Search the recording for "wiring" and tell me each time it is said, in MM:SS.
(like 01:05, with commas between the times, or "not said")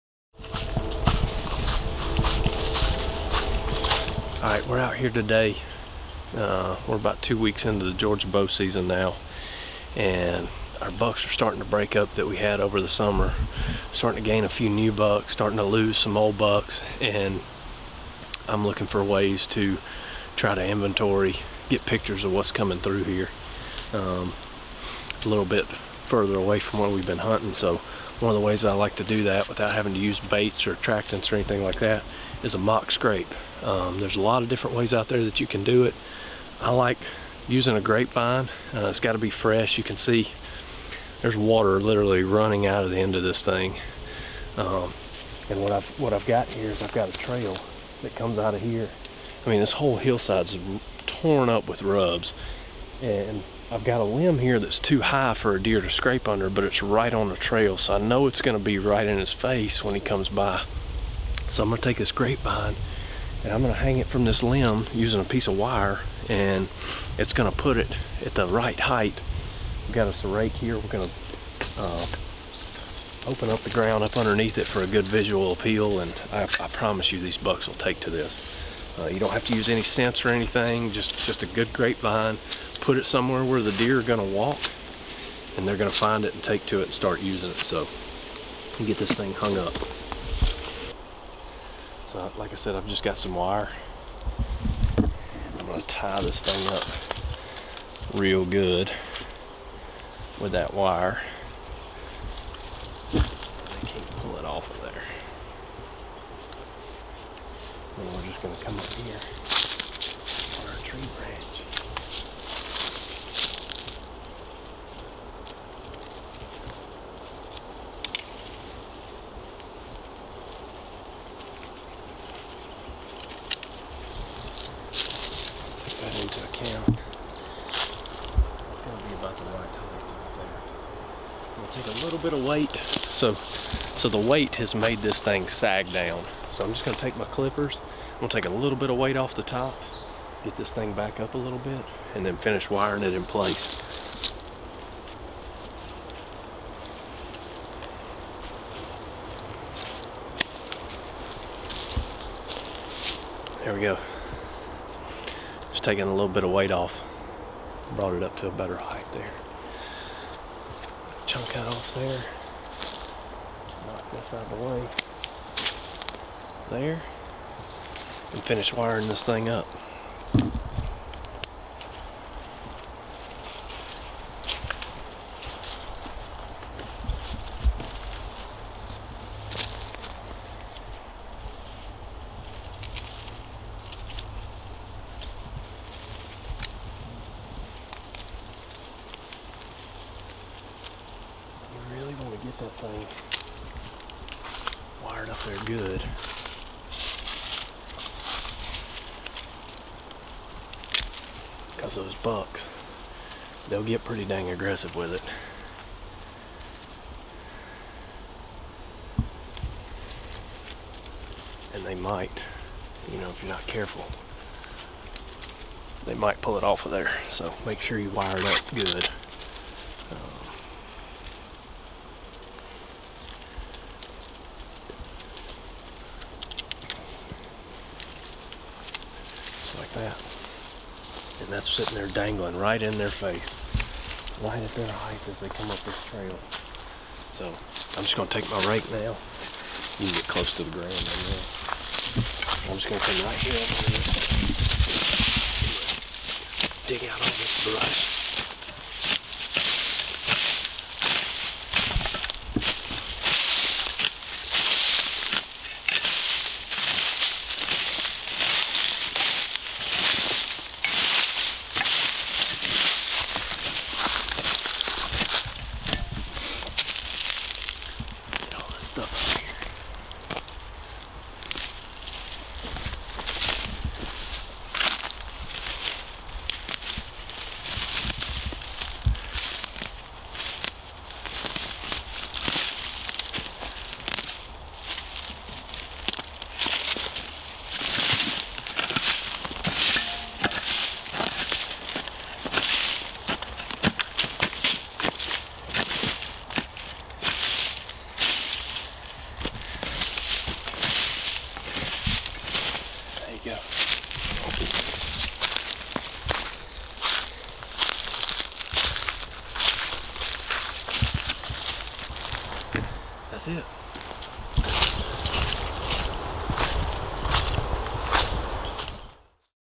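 02:22, 02:48.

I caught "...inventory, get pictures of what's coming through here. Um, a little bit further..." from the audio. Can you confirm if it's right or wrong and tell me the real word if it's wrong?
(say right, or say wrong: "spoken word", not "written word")
right.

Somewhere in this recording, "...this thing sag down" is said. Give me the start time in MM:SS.
02:15.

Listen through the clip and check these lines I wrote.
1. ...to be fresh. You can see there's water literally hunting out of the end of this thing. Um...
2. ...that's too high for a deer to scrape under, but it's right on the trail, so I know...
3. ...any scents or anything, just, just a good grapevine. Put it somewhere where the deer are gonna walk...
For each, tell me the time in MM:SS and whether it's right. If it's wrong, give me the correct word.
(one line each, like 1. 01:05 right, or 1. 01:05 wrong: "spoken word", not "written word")
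1. 00:39 wrong: "running", not "hunting"
2. 00:54 right
3. 01:19 right.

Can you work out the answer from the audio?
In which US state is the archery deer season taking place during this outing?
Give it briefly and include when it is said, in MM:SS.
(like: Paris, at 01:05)
Georgia, at 00:07.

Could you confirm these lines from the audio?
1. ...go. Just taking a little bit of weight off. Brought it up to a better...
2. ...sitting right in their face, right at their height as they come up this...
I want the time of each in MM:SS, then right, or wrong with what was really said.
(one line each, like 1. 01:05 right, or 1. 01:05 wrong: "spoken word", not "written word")
1. 02:33 right
2. 03:52 wrong: "dangling", not "sitting".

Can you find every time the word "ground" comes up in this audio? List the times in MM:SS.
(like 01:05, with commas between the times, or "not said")
01:13, 04:00.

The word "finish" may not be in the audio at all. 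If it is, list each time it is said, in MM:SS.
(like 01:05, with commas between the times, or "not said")
02:22, 02:48.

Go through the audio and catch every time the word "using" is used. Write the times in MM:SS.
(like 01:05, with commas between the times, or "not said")
00:37, 01:04, 01:27.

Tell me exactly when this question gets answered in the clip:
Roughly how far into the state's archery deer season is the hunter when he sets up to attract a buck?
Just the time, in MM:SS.
00:07.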